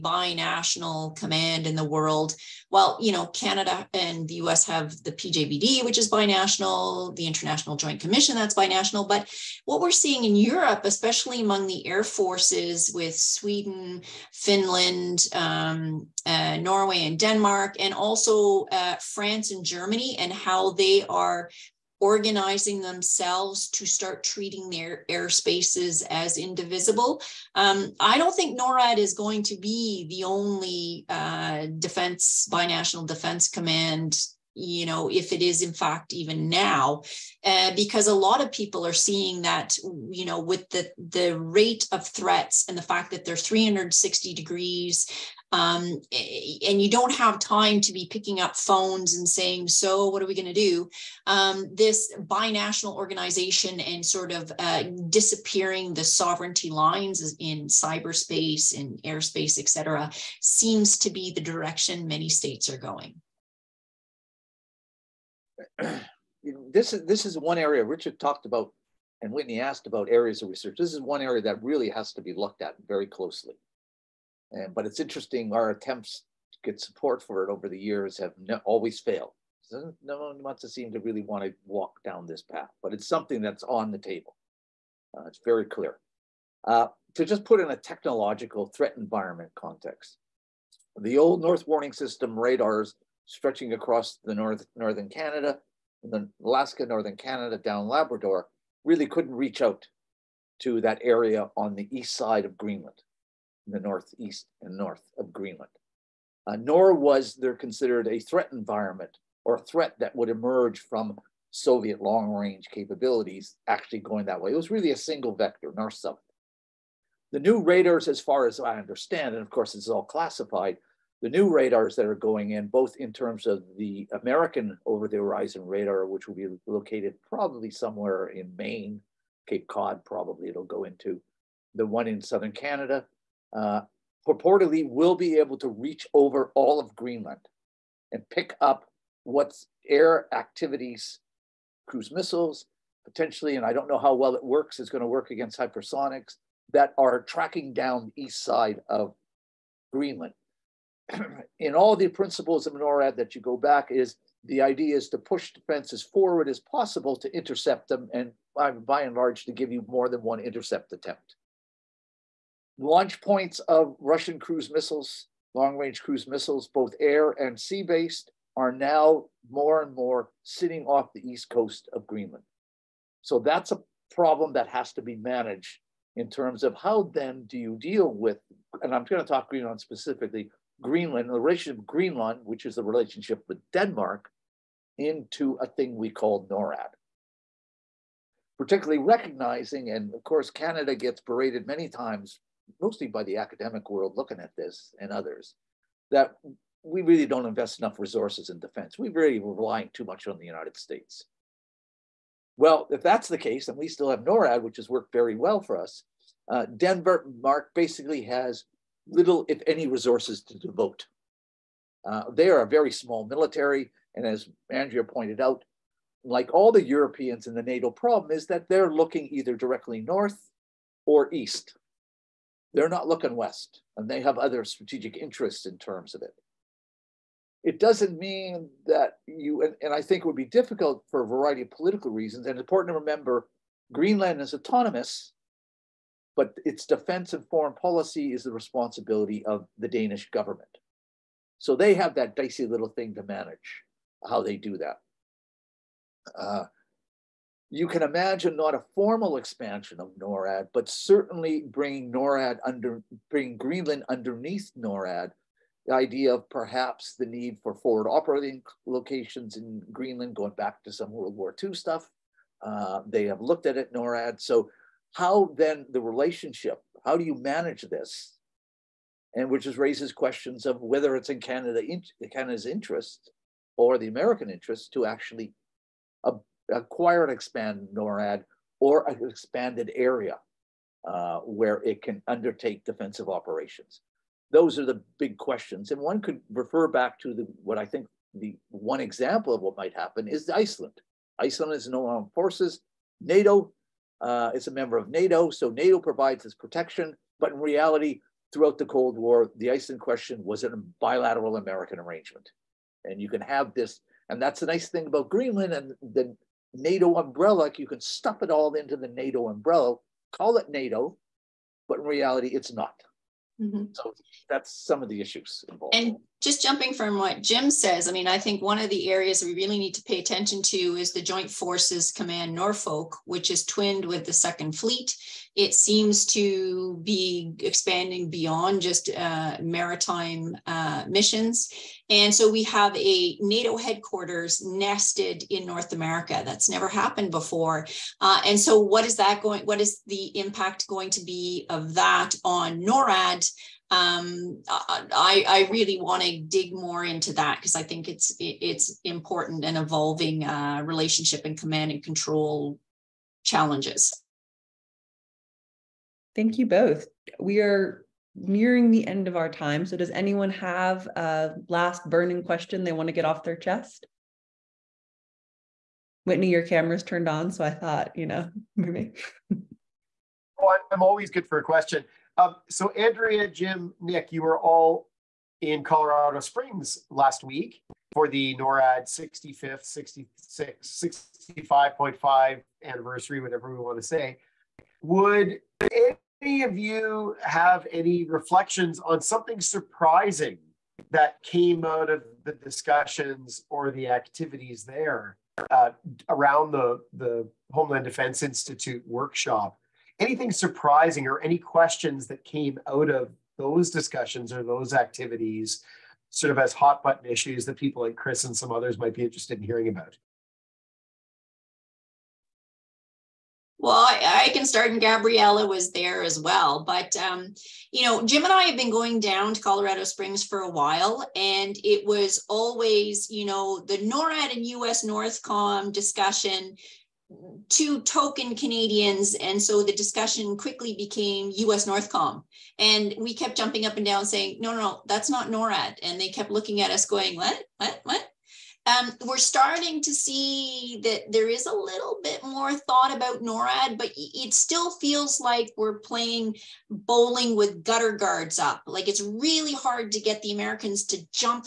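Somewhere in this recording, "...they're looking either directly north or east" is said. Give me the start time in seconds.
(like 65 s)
218 s.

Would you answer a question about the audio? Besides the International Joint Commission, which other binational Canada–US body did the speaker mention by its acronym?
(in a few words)
PJBD.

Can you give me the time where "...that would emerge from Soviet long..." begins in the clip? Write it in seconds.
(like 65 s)
109 s.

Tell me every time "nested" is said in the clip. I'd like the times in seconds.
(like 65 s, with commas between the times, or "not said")
334 s.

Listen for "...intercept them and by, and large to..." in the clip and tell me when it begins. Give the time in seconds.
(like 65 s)
157 s.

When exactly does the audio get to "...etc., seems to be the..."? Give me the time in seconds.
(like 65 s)
59 s.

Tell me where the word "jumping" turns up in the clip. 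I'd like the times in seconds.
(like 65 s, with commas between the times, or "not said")
316 s, 433 s.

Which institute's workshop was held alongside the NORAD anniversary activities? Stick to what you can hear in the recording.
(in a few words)
Homeland Defense Institute.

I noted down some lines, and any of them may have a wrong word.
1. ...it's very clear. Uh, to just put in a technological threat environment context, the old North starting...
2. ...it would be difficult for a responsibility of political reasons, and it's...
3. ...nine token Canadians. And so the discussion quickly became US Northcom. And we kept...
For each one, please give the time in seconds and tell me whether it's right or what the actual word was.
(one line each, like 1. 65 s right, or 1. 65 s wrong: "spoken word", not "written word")
1. 85 s wrong: "warning", not "starting"
2. 230 s wrong: "variety", not "responsibility"
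3. 427 s wrong: "two", not "nine".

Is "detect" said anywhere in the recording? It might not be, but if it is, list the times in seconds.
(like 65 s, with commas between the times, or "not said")
not said.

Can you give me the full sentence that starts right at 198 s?
We really were relying too much on the United States.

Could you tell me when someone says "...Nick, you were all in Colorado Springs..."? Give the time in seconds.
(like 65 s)
374 s.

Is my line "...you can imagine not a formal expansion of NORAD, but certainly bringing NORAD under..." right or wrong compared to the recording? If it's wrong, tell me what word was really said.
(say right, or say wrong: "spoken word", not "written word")
right.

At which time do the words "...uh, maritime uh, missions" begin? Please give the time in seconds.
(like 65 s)
329 s.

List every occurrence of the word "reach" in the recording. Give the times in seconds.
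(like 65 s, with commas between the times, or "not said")
99 s, 135 s.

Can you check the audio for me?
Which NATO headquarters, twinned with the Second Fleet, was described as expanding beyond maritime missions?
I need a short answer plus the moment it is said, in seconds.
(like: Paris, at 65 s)
Joint Forces Command Norfolk, at 321 s.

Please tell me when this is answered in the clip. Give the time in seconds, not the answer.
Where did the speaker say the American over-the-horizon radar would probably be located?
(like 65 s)
128 s.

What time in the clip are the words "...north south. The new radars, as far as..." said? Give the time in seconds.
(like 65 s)
115 s.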